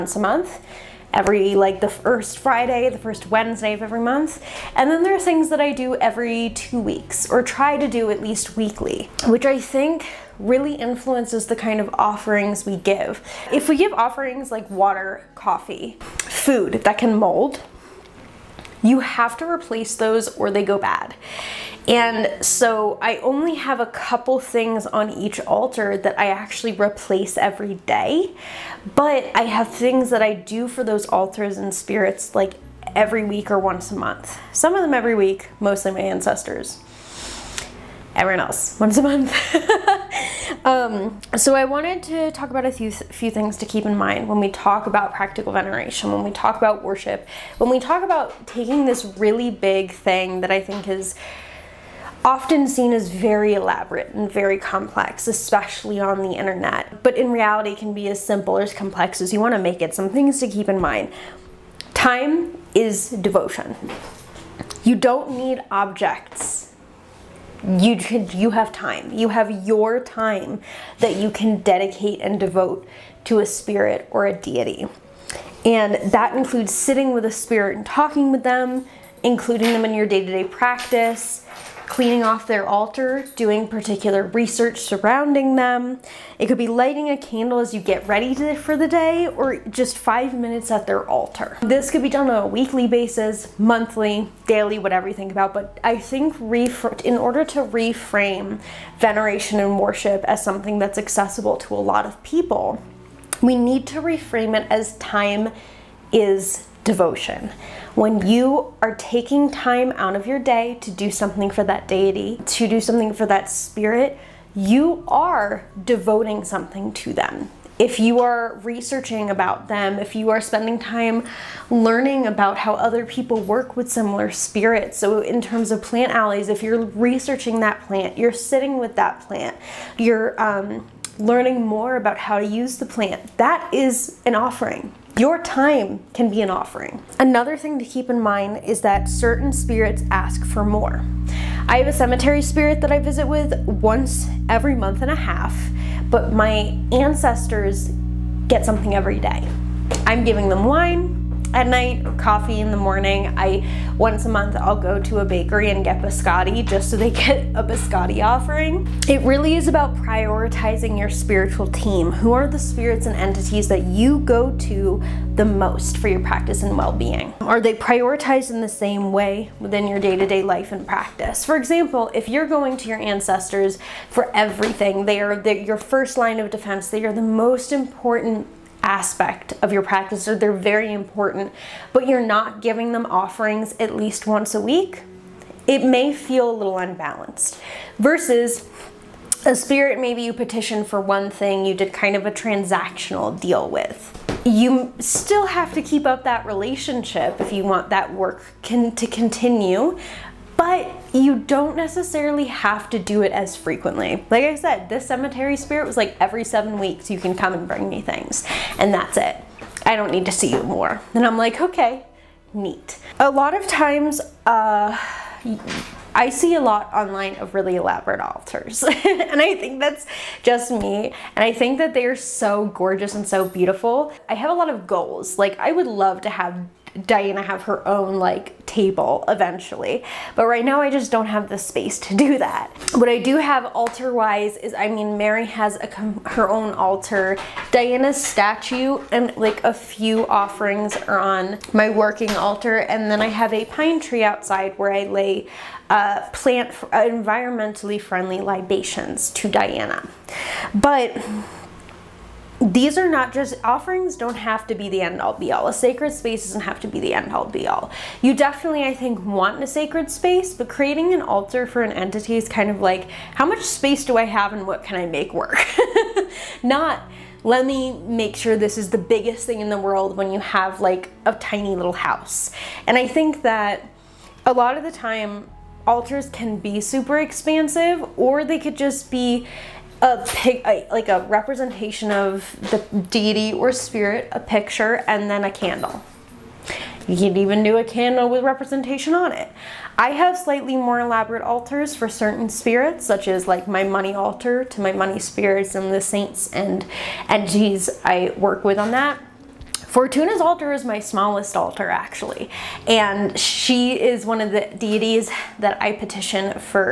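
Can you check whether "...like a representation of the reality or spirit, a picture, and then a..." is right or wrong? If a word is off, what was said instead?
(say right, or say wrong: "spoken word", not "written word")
wrong: "deity", not "reality".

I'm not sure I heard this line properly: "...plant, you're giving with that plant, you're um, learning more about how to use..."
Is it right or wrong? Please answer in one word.
wrong.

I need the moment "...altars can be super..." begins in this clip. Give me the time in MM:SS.
04:35.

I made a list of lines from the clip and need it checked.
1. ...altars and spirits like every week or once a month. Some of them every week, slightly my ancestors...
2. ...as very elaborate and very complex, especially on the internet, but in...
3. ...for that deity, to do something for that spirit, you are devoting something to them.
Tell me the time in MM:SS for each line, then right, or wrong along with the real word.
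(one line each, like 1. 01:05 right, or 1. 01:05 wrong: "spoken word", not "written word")
1. 00:31 wrong: "mostly", not "slightly"
2. 00:52 right
3. 01:51 right.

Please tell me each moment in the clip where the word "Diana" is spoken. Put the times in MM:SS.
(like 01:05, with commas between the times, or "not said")
03:47, 03:57, 04:09.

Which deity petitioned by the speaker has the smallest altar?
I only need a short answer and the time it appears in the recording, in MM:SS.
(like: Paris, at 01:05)
Fortuna, at 04:59.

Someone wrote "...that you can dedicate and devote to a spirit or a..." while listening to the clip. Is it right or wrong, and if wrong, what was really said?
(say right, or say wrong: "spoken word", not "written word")
right.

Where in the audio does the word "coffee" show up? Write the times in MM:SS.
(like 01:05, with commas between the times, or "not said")
00:15, 02:32.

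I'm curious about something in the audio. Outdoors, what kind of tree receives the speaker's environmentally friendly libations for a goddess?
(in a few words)
Pine tree.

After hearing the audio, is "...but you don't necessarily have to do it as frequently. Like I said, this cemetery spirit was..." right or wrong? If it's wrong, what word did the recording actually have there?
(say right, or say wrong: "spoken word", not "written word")
right.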